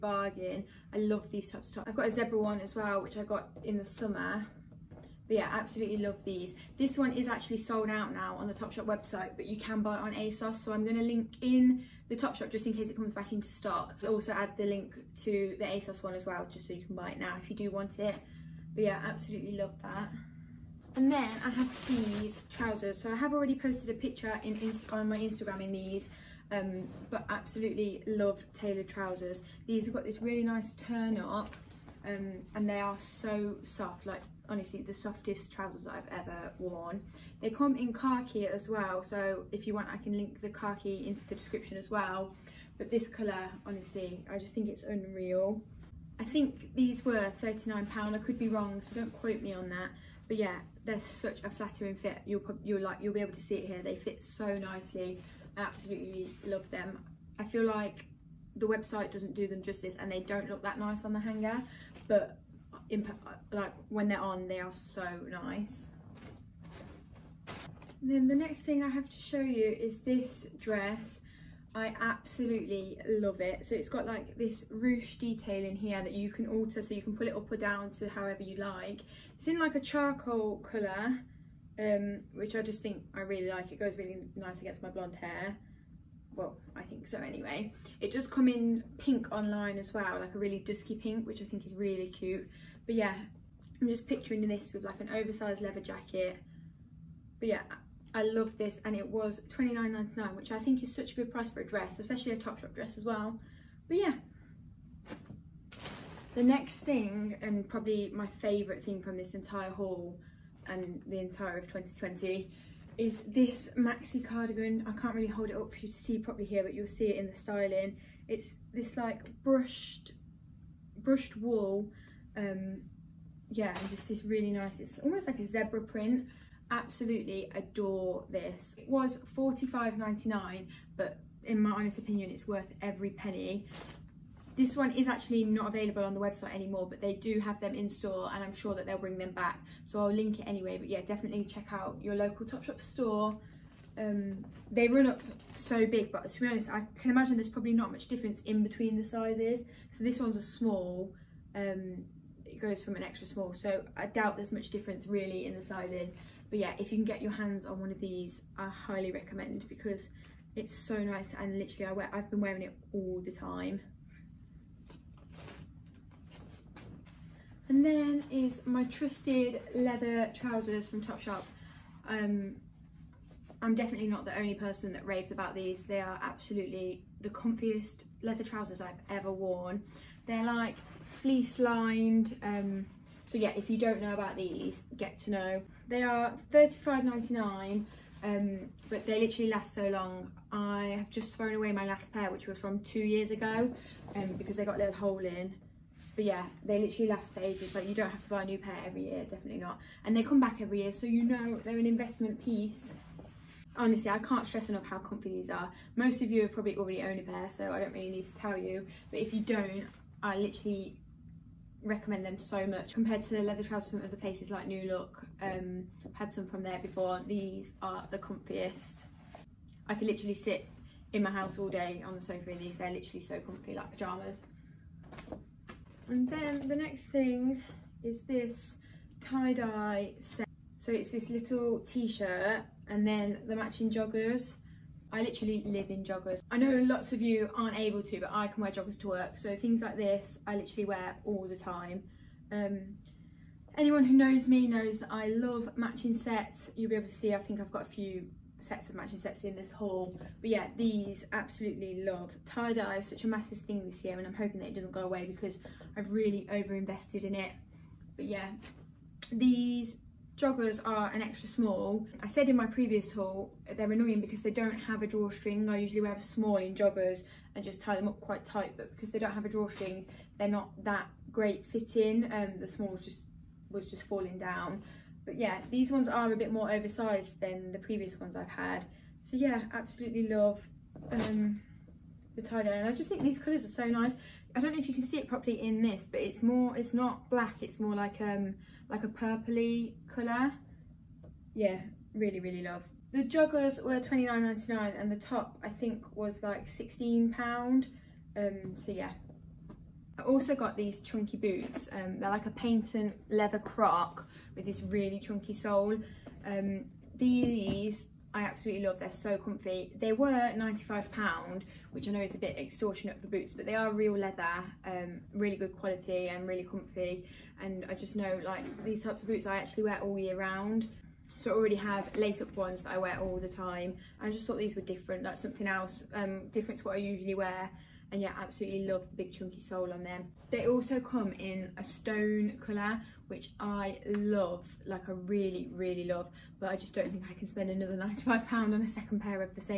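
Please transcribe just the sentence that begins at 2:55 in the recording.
They are absolutely the comfiest leather trousers I've ever worn.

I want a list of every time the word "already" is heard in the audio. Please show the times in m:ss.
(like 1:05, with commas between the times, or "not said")
0:23, 3:26, 5:21.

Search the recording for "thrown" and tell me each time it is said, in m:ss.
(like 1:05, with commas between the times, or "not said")
3:11.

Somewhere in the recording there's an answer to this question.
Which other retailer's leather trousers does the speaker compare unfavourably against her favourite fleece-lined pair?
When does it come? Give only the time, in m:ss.
3:34.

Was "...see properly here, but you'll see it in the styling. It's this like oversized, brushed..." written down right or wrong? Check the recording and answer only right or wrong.
wrong.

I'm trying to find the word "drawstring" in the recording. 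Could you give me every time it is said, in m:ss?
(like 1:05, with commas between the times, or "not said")
4:25, 4:29.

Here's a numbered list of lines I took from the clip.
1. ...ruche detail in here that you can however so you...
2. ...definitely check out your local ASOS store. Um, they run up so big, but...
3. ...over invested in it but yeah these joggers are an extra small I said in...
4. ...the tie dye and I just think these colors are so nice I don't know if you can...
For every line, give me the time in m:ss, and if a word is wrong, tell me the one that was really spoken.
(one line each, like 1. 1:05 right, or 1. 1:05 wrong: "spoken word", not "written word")
1. 1:14 wrong: "alter", not "however"
2. 2:21 wrong: "Topshop", not "ASOS"
3. 4:16 right
4. 4:42 right.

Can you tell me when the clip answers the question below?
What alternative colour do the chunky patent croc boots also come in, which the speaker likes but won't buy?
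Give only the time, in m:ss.
5:31.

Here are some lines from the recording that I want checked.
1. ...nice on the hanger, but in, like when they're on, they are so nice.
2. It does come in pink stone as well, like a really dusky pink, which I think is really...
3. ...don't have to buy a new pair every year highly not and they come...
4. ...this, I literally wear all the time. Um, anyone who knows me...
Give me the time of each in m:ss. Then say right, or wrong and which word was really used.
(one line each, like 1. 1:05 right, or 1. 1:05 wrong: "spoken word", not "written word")
1. 1:00 right
2. 1:27 wrong: "online", not "stone"
3. 3:17 wrong: "definitely", not "highly"
4. 3:59 right.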